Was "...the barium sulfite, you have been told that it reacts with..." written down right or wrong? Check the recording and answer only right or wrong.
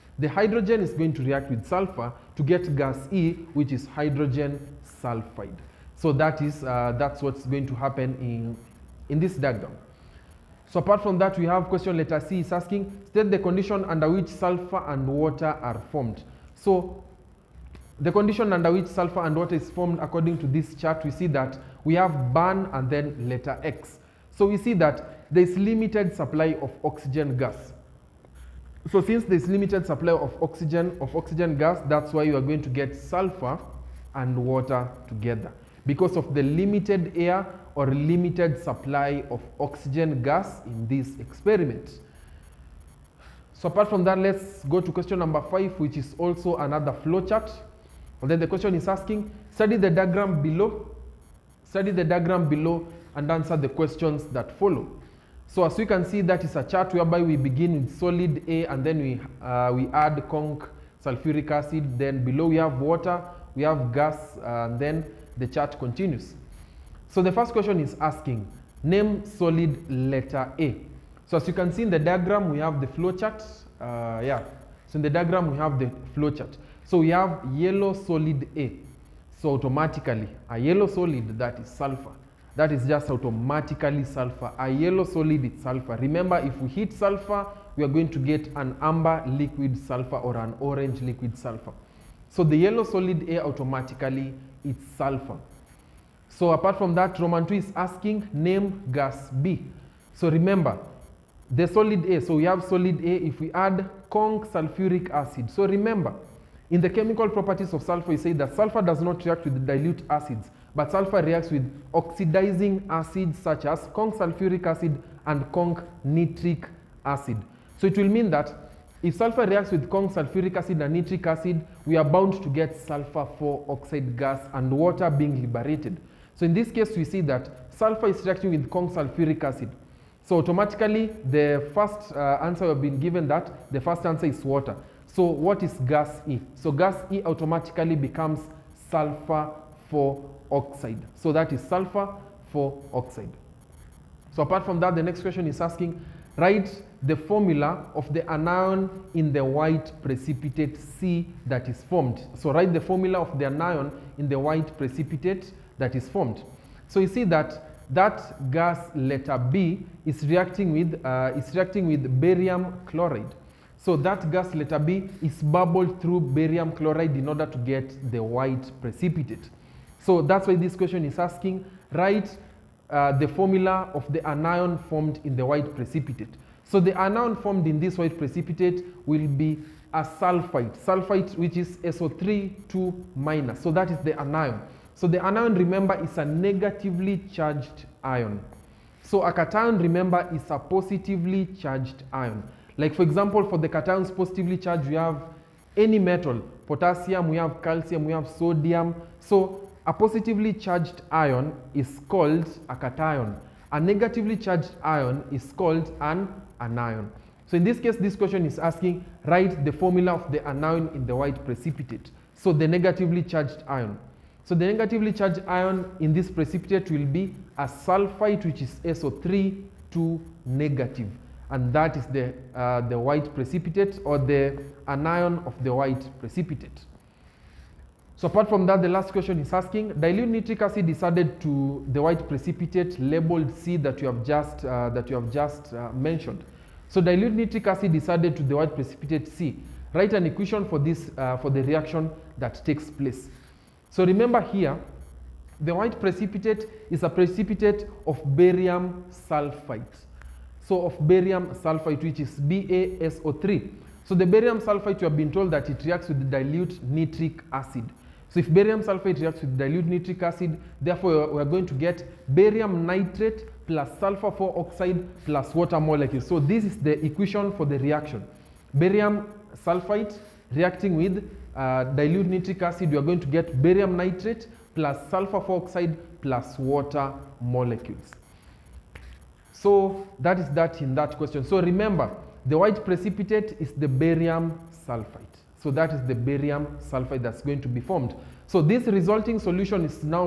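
right.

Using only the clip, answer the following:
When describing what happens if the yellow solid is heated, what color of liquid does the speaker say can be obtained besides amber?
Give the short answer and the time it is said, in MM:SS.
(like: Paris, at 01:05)
Orange, at 01:30.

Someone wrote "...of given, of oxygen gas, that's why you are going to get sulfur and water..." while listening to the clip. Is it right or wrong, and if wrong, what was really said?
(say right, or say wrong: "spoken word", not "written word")
wrong: "oxygen", not "given".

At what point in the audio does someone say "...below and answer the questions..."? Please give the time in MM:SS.
00:52.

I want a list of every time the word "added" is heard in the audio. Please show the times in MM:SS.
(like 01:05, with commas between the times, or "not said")
03:51, 03:58.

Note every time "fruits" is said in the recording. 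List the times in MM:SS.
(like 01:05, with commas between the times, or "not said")
not said.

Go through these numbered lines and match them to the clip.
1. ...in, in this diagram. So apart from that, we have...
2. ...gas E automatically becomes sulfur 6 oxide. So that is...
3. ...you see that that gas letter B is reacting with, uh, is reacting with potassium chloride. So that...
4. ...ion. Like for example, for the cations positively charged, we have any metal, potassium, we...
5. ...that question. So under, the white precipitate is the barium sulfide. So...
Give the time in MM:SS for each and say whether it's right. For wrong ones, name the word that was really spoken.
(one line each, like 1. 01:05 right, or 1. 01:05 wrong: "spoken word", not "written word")
1. 00:08 right
2. 02:16 wrong: "4", not "6"
3. 02:36 wrong: "barium", not "potassium"
4. 03:12 right
5. 04:40 wrong: "remember", not "under".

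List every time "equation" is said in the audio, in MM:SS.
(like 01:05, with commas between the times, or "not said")
04:00, 04:27.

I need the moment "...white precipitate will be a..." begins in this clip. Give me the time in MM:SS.
02:57.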